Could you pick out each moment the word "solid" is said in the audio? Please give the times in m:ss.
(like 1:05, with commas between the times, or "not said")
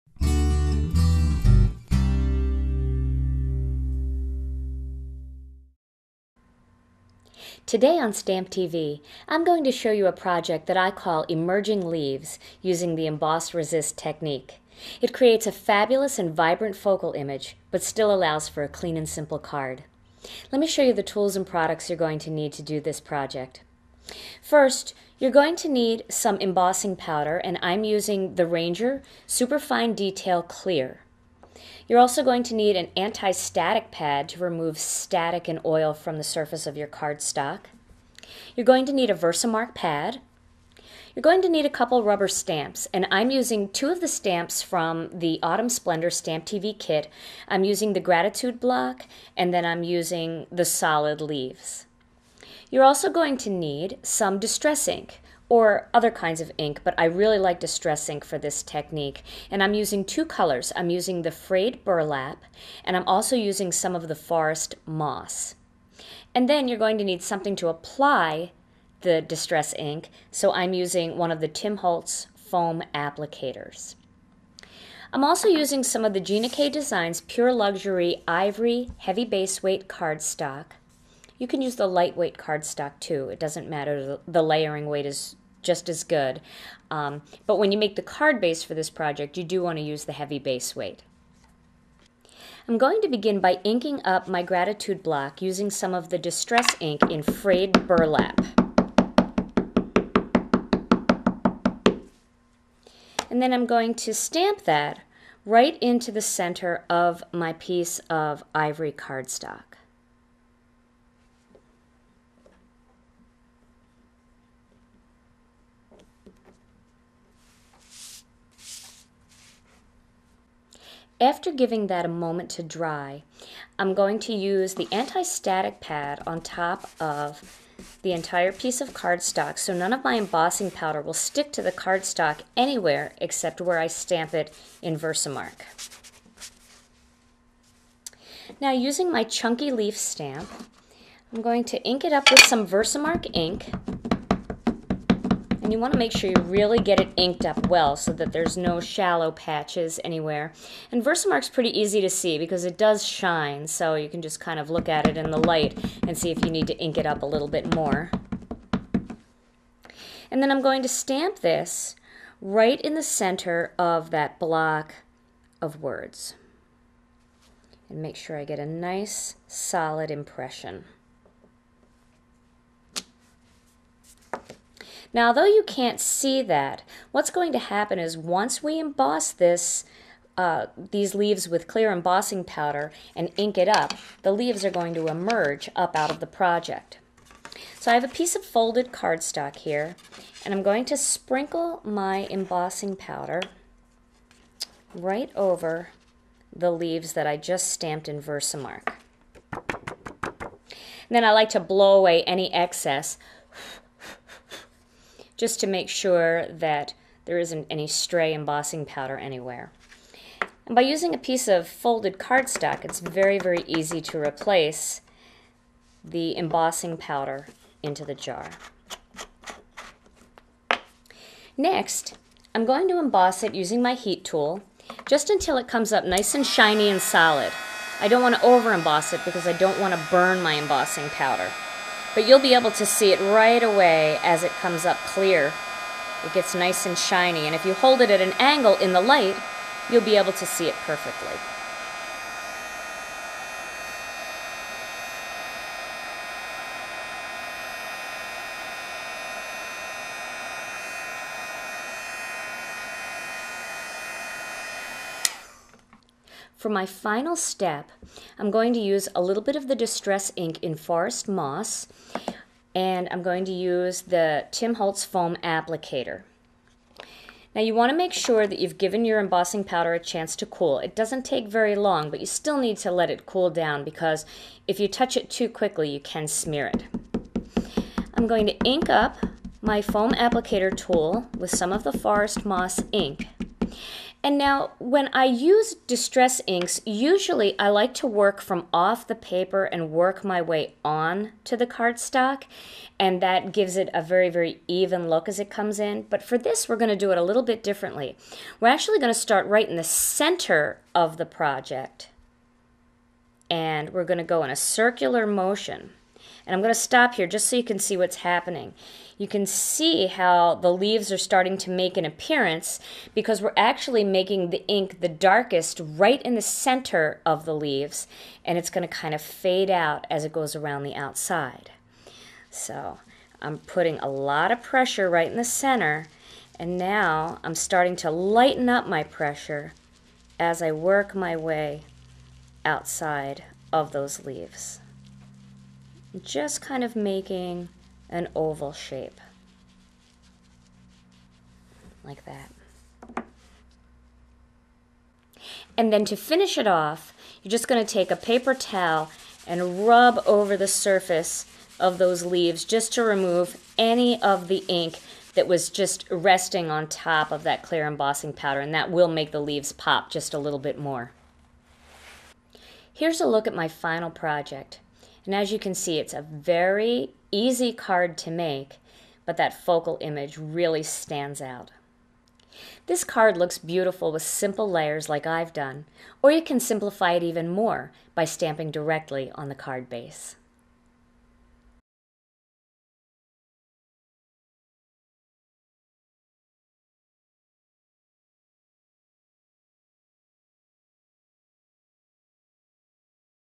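0:50, 2:49, 3:47.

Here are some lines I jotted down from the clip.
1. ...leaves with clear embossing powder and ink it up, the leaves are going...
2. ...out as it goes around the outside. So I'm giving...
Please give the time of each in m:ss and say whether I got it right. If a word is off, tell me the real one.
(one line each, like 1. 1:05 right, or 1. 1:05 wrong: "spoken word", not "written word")
1. 3:01 right
2. 5:19 wrong: "putting", not "giving".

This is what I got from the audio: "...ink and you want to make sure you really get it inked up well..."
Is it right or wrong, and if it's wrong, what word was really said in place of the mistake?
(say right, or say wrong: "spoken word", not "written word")
right.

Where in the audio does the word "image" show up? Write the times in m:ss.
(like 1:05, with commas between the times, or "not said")
0:17, 6:10.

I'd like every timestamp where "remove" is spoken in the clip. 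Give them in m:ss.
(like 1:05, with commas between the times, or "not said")
0:34, 5:53.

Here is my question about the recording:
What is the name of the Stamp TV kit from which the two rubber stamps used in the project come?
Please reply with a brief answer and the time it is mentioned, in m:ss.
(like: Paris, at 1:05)
Autumn Splendor, at 0:45.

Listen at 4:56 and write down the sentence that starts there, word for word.
But for this, we're going to do it a little bit differently.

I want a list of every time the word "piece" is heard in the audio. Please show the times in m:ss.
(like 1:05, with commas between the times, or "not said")
1:47, 2:08, 3:08, 3:31.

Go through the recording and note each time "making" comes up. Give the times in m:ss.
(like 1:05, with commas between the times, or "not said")
5:14, 5:36.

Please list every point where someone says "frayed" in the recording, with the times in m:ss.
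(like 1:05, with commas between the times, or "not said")
1:01, 1:37.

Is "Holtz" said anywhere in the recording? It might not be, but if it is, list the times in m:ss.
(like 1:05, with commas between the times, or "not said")
1:11, 4:24.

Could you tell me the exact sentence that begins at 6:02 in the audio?
Here's a look at my final project.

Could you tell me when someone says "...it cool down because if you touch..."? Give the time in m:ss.
4:33.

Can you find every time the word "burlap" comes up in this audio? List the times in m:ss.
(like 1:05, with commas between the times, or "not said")
1:01, 1:37.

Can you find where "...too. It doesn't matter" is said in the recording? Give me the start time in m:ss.
1:23.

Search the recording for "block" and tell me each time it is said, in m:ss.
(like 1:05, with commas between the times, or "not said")
0:48, 1:35, 2:44.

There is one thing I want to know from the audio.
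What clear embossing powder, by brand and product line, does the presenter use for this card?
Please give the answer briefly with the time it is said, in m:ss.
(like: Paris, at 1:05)
Ranger Superfine Detail Clear, at 0:28.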